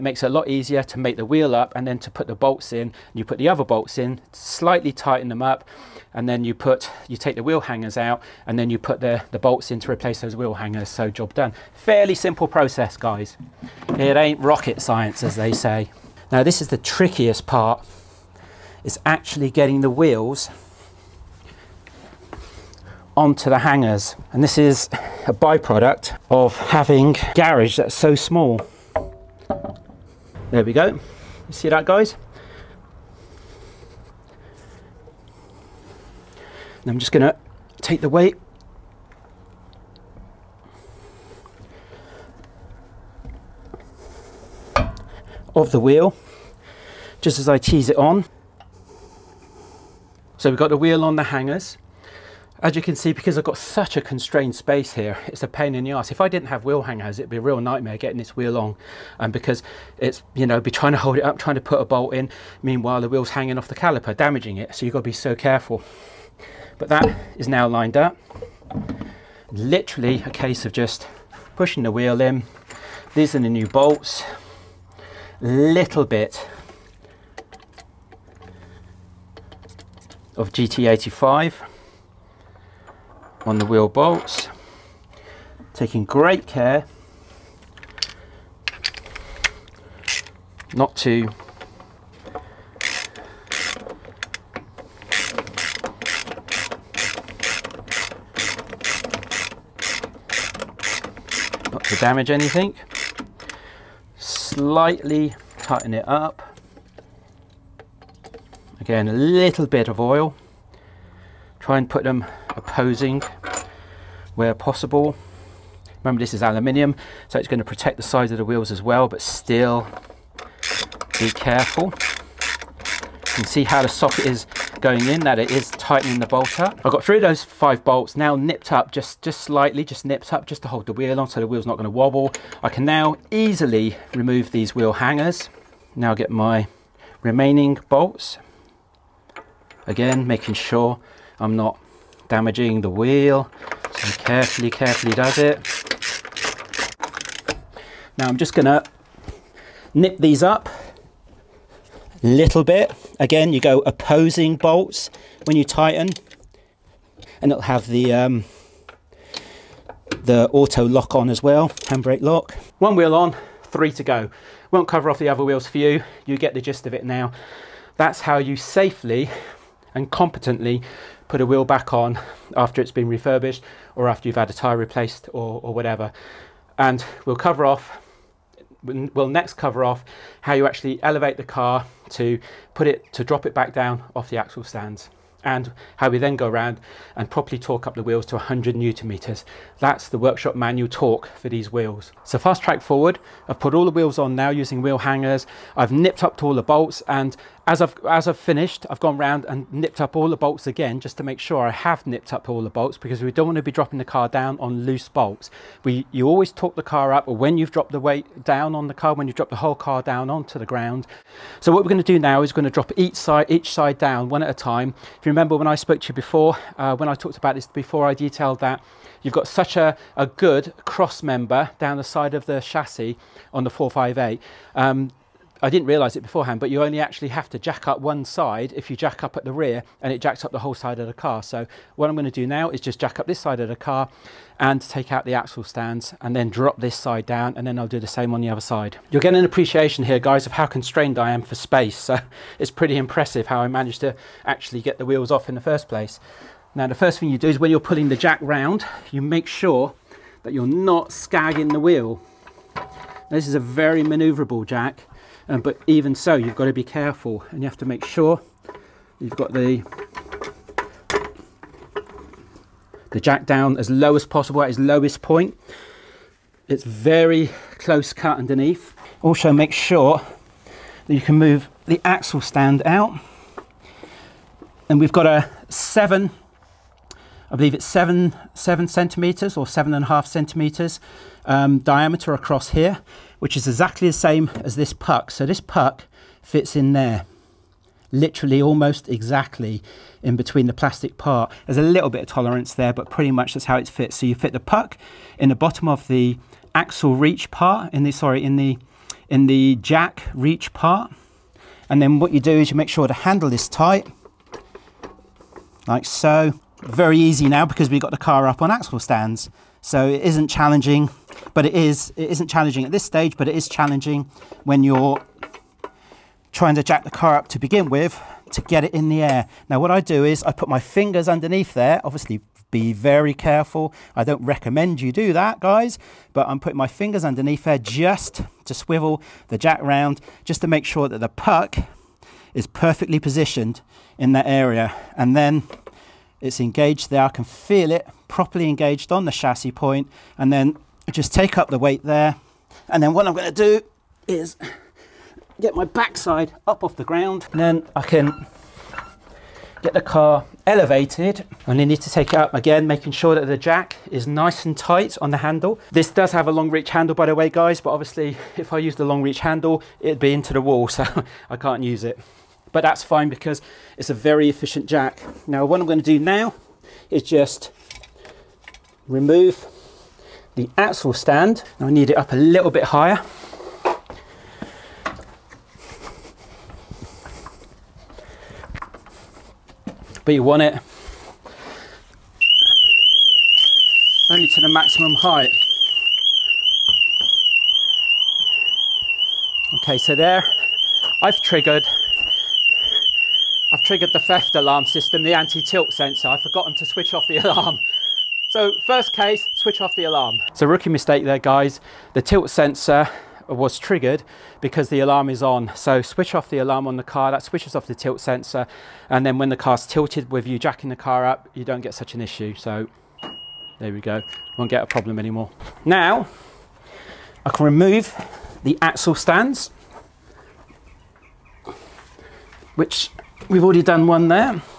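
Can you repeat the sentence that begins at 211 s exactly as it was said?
So what we're going to do now is going to drop each side, each side down one at a time.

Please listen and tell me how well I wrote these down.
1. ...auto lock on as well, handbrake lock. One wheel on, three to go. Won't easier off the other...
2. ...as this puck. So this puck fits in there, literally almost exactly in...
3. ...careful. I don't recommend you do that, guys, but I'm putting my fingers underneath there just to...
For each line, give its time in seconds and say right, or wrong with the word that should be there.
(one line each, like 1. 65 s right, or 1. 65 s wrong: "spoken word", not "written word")
1. 160 s wrong: "cover", not "easier"
2. 284 s right
3. 323 s right.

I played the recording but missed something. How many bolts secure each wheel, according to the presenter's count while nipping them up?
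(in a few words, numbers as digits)
5.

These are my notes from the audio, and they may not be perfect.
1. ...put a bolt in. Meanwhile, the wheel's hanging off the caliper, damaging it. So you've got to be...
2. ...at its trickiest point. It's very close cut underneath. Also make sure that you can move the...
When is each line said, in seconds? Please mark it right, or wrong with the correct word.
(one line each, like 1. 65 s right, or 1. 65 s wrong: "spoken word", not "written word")
1. 61 s right
2. 264 s wrong: "lowest", not "trickiest".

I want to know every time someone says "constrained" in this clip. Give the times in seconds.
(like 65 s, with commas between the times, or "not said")
54 s, 240 s.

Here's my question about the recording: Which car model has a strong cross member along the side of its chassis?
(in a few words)
458.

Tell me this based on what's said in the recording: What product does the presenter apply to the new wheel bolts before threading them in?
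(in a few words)
GT85.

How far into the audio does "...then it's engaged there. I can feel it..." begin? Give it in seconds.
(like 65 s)
335 s.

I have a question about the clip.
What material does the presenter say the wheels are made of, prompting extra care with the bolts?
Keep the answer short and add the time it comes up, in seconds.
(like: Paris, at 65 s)
Aluminium, at 116 s.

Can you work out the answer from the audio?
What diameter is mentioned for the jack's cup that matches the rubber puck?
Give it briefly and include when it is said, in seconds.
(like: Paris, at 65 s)
7.5 centimeters, at 279 s.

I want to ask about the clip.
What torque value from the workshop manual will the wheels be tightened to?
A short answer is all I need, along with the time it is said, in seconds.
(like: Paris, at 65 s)
100 newton meters, at 188 s.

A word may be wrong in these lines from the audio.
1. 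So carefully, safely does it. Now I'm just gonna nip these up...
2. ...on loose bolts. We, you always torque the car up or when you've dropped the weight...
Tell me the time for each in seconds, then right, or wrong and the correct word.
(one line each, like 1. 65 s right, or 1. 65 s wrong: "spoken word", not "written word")
1. 143 s wrong: "carefully", not "safely"
2. 204 s right.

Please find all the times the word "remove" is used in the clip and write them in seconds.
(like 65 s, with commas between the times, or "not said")
134 s, 369 s, 417 s.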